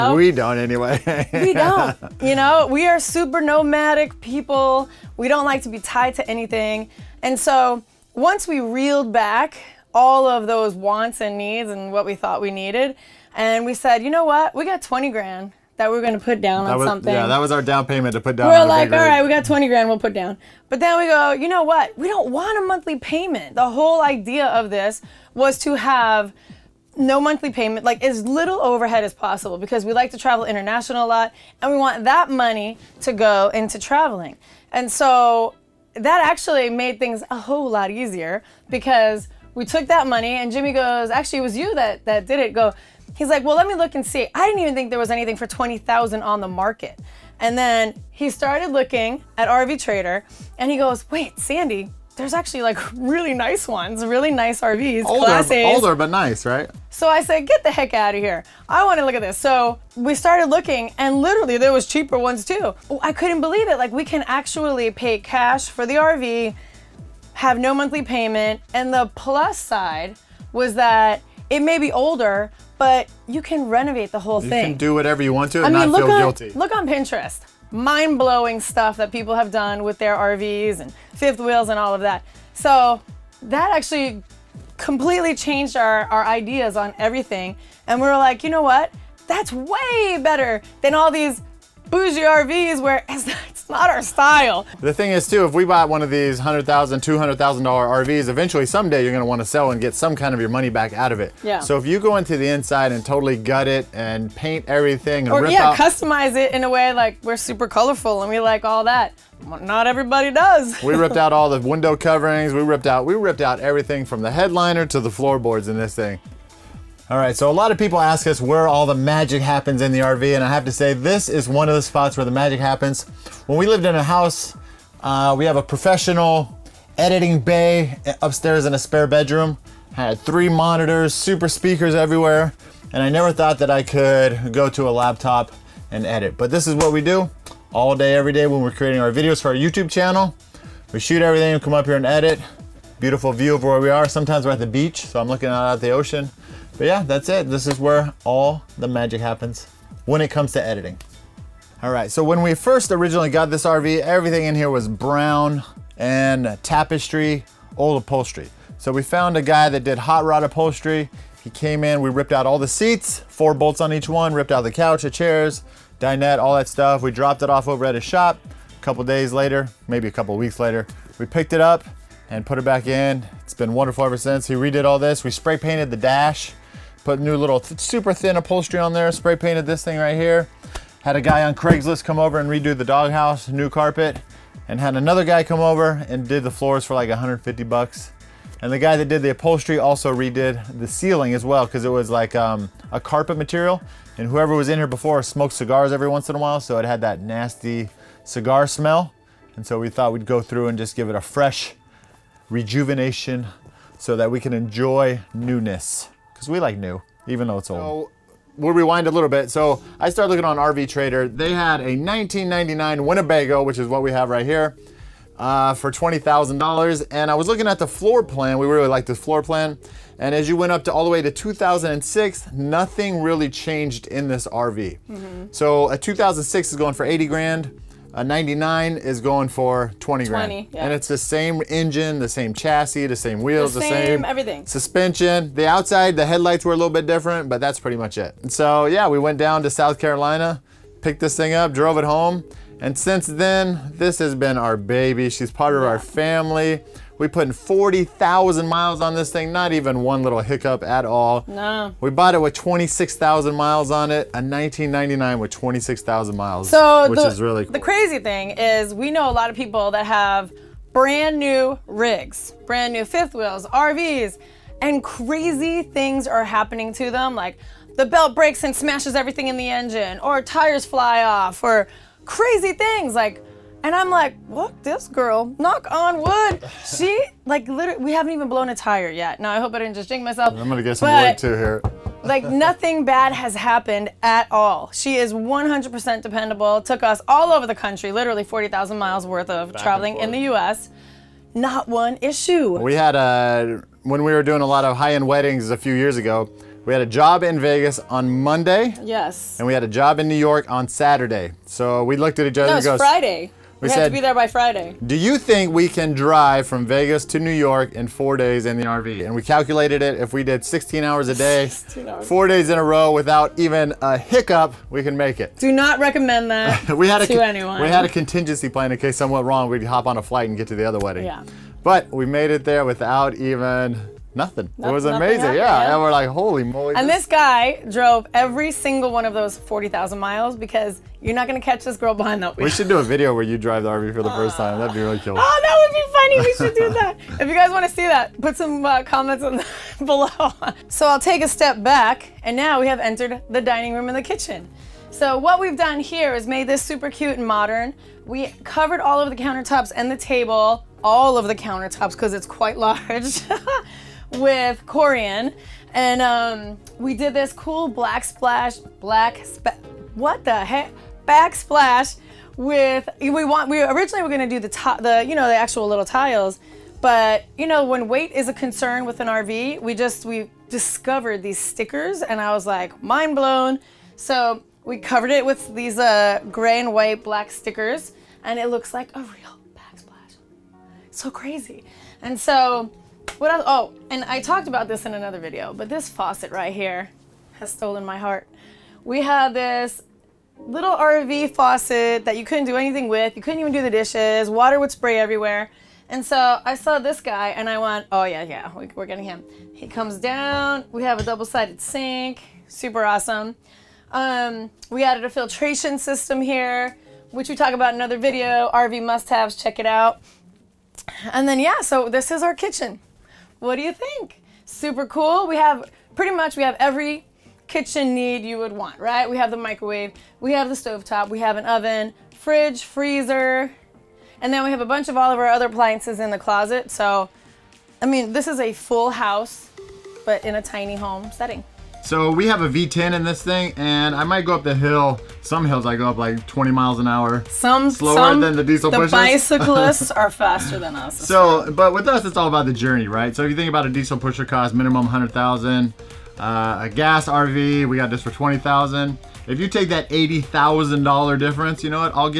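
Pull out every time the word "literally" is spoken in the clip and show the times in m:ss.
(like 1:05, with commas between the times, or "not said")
1:01, 4:37, 4:48.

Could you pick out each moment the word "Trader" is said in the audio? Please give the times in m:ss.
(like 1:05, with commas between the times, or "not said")
0:49, 3:30.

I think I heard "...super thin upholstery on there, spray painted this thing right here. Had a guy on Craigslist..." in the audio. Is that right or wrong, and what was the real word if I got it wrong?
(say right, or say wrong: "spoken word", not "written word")
right.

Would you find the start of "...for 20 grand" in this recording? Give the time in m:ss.
3:49.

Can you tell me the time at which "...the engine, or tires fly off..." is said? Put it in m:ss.
4:29.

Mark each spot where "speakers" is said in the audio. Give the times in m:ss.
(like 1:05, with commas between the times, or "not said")
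2:11.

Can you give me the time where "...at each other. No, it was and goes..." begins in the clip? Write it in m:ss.
5:02.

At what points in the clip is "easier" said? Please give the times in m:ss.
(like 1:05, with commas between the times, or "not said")
0:37.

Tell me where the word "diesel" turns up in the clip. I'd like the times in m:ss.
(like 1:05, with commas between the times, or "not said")
7:18, 7:23.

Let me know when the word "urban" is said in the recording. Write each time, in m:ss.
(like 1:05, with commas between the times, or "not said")
not said.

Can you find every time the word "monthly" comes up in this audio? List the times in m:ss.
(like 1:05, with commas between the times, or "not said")
0:22, 0:27, 1:07.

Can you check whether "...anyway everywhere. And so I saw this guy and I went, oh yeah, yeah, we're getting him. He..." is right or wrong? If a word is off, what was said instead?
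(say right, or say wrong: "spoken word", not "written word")
wrong: "spray", not "anyway".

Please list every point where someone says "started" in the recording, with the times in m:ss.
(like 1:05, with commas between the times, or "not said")
0:48, 1:00, 3:30.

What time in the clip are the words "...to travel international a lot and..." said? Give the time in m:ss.
0:30.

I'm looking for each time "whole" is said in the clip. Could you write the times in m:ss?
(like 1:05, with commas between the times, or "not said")
0:23, 0:37, 1:14.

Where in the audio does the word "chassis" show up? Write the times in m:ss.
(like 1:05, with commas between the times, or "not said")
3:52.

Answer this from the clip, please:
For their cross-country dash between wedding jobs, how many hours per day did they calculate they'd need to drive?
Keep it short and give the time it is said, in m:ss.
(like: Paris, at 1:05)
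16, at 5:10.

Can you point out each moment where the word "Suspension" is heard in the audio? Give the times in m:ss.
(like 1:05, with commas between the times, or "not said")
3:54.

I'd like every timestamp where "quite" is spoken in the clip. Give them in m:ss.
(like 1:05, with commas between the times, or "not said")
5:52.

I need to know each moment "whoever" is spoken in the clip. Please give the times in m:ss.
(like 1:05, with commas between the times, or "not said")
3:14.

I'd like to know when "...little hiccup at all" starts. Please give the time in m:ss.
4:10.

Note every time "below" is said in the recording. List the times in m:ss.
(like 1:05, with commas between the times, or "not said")
5:40.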